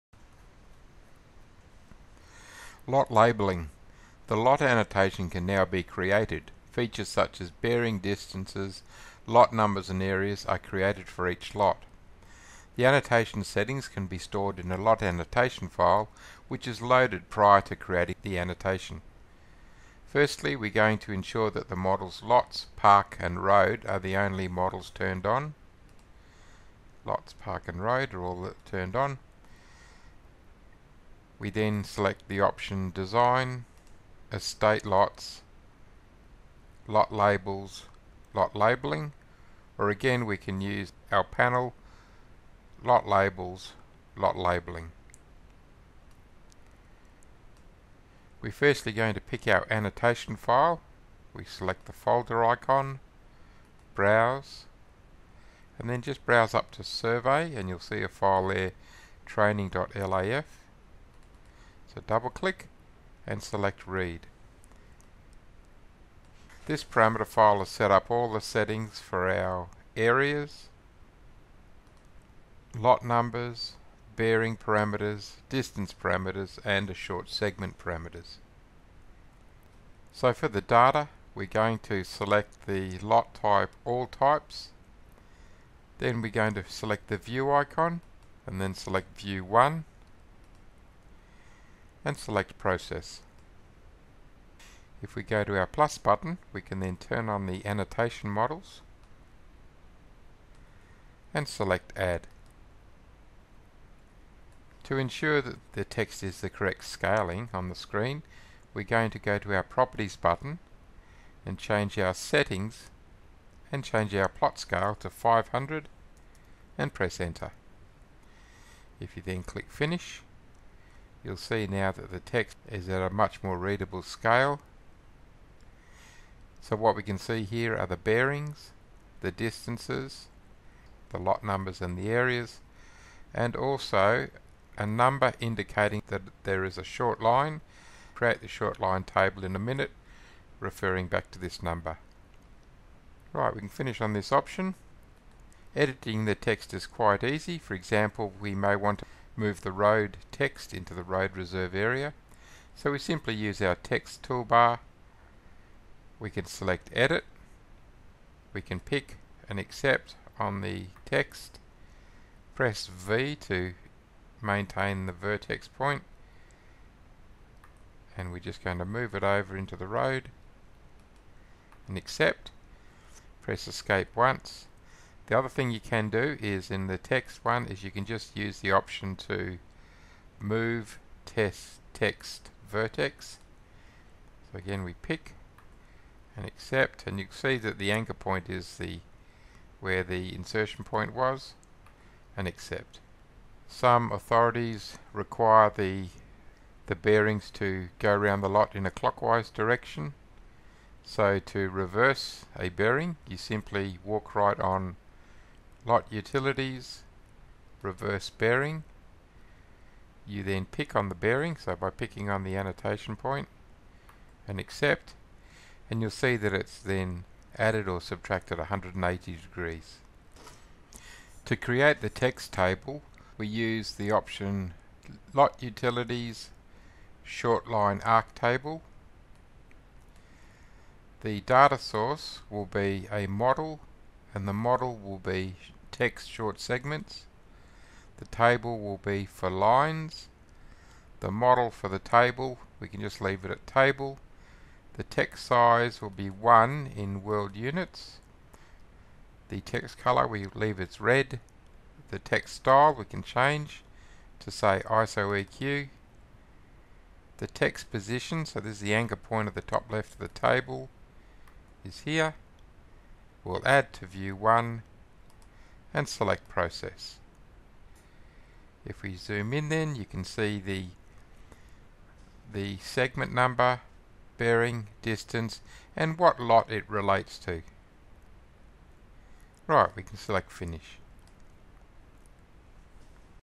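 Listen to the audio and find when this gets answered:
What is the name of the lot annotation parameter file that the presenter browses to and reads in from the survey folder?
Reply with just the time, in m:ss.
0:59.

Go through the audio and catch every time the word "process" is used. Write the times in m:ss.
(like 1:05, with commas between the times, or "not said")
1:32, 4:26.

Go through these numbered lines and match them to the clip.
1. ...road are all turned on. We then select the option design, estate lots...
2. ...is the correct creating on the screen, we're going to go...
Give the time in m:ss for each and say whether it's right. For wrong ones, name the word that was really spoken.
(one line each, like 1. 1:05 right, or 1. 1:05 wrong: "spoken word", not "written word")
1. 0:27 right
2. 1:46 wrong: "scaling", not "creating".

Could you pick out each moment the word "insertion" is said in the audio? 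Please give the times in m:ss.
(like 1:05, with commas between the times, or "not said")
3:10.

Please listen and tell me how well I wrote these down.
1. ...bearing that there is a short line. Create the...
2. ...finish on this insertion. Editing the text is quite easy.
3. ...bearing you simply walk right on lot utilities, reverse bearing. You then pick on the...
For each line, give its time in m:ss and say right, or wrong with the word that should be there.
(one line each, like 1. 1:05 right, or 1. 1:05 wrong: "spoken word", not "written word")
1. 2:15 wrong: "indicating", not "bearing"
2. 2:23 wrong: "option", not "insertion"
3. 3:22 right.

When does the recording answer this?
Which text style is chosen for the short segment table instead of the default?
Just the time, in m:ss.
4:14.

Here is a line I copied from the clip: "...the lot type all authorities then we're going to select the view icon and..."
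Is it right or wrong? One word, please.
wrong.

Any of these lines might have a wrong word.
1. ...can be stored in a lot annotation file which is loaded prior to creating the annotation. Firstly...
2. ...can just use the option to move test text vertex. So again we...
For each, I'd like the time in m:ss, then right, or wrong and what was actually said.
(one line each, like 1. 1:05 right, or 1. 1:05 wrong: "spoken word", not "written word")
1. 0:13 right
2. 2:57 right.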